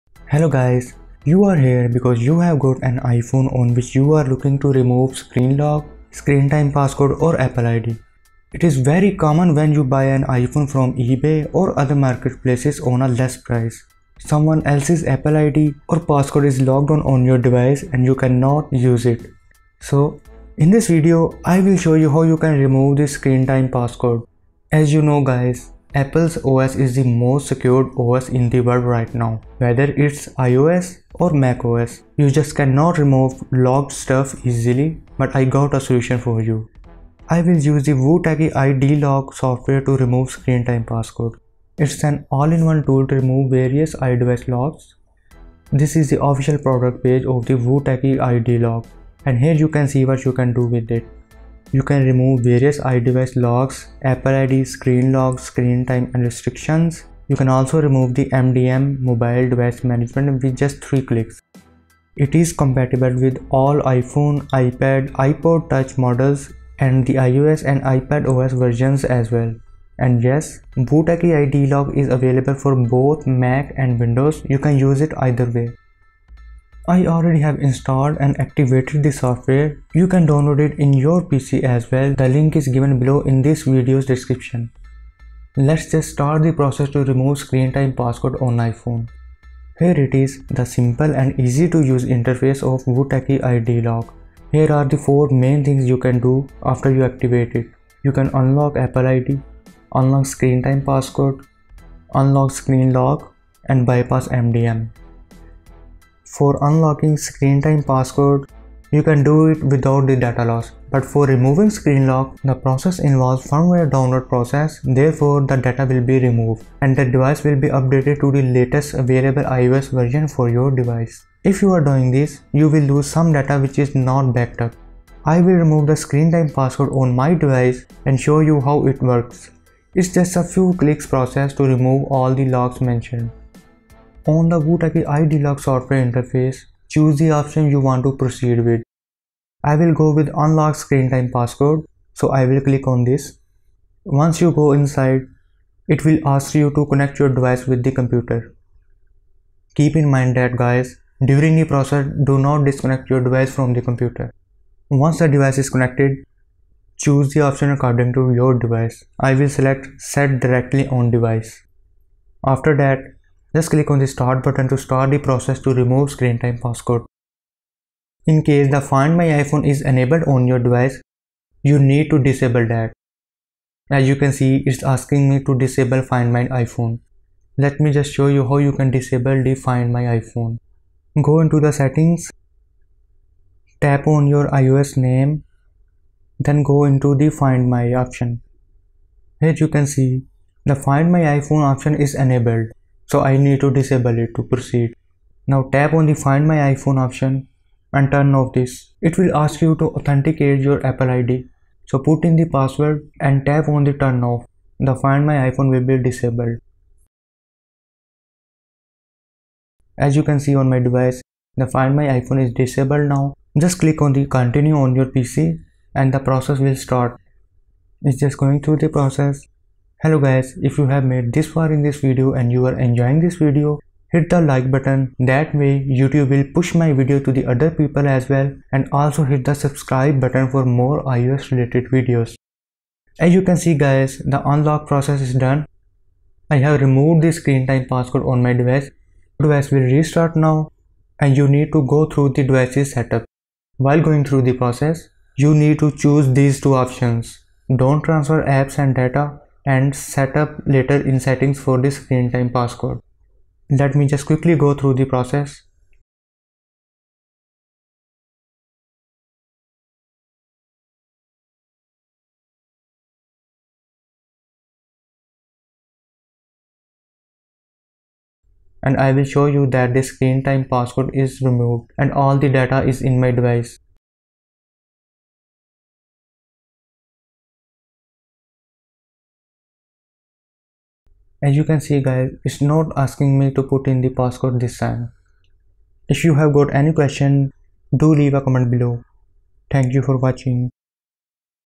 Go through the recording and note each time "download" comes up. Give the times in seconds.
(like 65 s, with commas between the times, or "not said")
80 s, 113 s.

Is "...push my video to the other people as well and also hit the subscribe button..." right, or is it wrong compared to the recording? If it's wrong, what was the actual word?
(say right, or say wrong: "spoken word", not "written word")
right.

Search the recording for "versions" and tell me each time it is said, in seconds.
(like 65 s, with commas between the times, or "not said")
68 s, 119 s.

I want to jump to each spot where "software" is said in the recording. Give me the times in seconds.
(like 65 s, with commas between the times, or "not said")
39 s, 79 s, 135 s.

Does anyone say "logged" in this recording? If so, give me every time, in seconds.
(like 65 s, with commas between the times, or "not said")
16 s, 33 s.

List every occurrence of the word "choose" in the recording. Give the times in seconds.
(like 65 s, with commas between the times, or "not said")
136 s, 156 s, 245 s.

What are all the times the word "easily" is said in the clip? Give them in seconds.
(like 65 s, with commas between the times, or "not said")
34 s.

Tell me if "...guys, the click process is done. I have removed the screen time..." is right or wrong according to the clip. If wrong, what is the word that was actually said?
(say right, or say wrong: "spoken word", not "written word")
wrong: "unlock", not "click".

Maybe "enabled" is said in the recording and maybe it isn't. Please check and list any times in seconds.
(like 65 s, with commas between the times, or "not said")
169 s, 192 s.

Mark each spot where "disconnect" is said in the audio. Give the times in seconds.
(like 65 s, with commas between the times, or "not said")
152 s.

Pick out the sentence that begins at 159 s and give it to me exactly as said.
I will select set directly on device.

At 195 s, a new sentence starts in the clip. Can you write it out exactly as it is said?
Now tap on the find my iPhone option and turn off this.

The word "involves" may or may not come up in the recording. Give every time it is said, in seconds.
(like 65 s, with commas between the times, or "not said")
112 s.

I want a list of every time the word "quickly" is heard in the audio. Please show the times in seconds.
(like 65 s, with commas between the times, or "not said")
254 s.